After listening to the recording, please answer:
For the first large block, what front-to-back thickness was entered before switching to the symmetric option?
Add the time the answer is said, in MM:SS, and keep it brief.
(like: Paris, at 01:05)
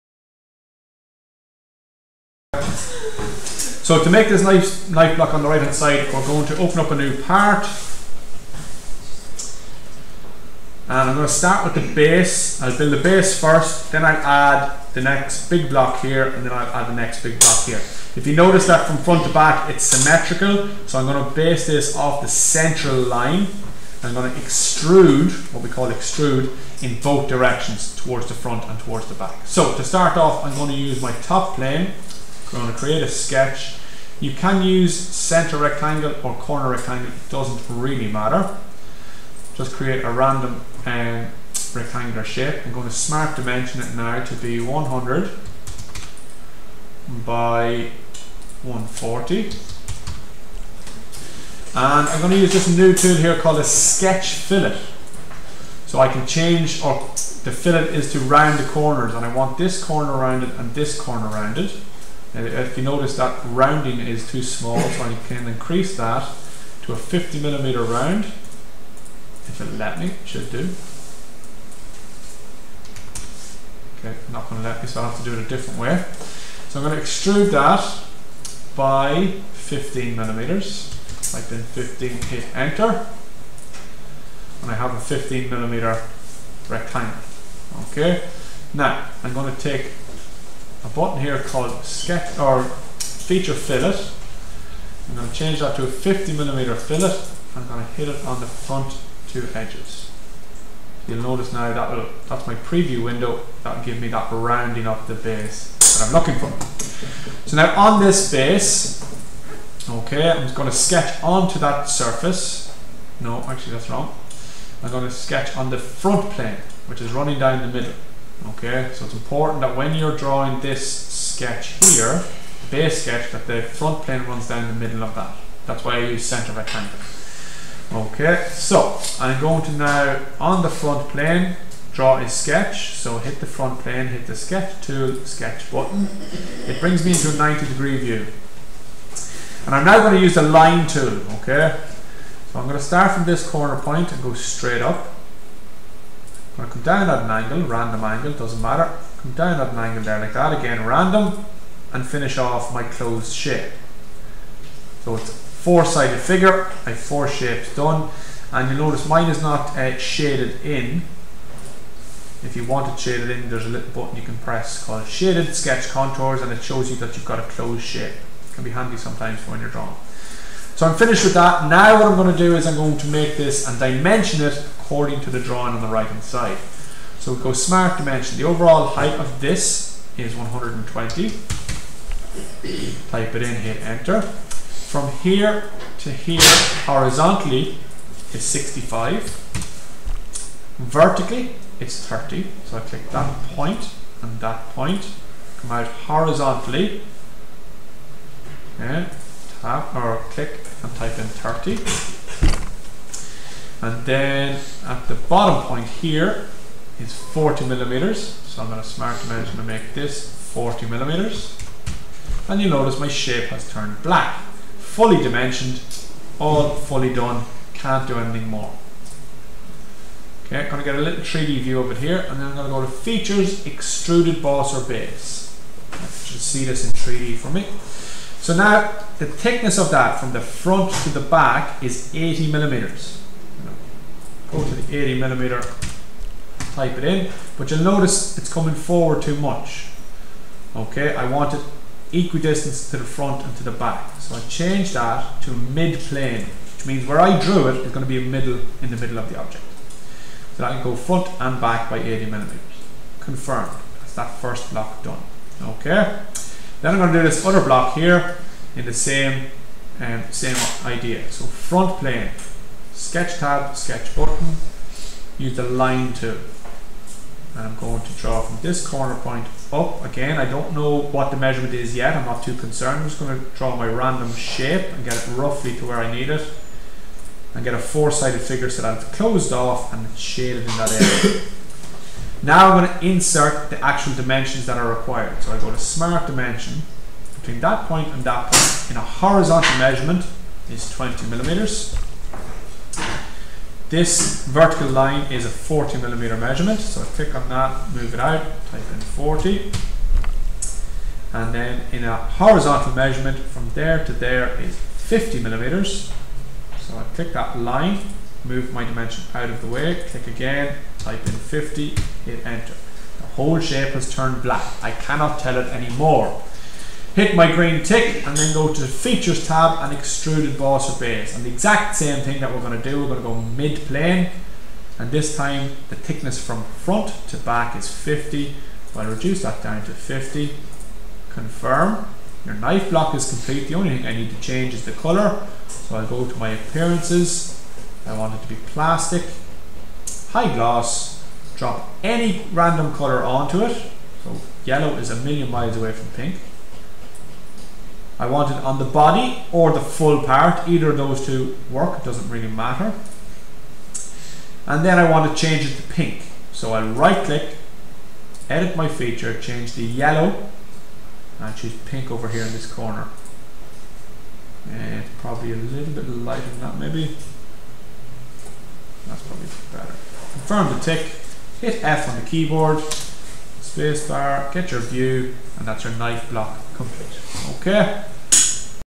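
80 millimeters, at 03:54.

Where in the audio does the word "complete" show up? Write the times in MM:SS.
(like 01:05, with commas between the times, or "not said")
05:33, 06:16.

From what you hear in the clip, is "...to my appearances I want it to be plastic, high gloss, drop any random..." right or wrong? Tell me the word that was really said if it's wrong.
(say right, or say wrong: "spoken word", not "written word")
right.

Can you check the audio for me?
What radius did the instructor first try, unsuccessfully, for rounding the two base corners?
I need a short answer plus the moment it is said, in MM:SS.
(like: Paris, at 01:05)
50 millimeters, at 01:06.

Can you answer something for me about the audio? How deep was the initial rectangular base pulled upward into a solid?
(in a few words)
15 millimeters.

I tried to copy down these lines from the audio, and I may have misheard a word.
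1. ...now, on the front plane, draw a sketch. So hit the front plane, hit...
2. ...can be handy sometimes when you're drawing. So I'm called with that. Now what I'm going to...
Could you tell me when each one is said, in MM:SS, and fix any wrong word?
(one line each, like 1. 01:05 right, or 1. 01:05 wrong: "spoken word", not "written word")
1. 02:09 right
2. 02:48 wrong: "finished", not "called".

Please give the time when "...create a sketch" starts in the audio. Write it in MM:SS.
00:32.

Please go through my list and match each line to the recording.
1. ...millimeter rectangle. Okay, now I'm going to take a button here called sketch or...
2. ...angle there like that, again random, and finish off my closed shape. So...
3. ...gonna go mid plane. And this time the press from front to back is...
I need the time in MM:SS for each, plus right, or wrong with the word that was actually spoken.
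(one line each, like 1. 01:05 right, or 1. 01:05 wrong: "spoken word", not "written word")
1. 01:25 right
2. 02:29 right
3. 05:23 wrong: "thickness", not "press".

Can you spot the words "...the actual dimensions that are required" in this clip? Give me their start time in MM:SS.
04:43.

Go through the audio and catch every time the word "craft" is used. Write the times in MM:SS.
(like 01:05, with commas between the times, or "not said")
not said.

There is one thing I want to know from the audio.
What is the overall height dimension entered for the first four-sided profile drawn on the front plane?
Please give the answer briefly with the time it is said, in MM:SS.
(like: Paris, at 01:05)
120, at 03:00.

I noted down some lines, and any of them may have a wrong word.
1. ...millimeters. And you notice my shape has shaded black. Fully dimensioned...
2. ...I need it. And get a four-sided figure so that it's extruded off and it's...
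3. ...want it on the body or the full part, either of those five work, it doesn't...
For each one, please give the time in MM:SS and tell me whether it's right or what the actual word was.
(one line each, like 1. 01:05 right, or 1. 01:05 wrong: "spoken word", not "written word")
1. 03:30 wrong: "turned", not "shaded"
2. 04:35 wrong: "closed", not "extruded"
3. 05:48 wrong: "two", not "five".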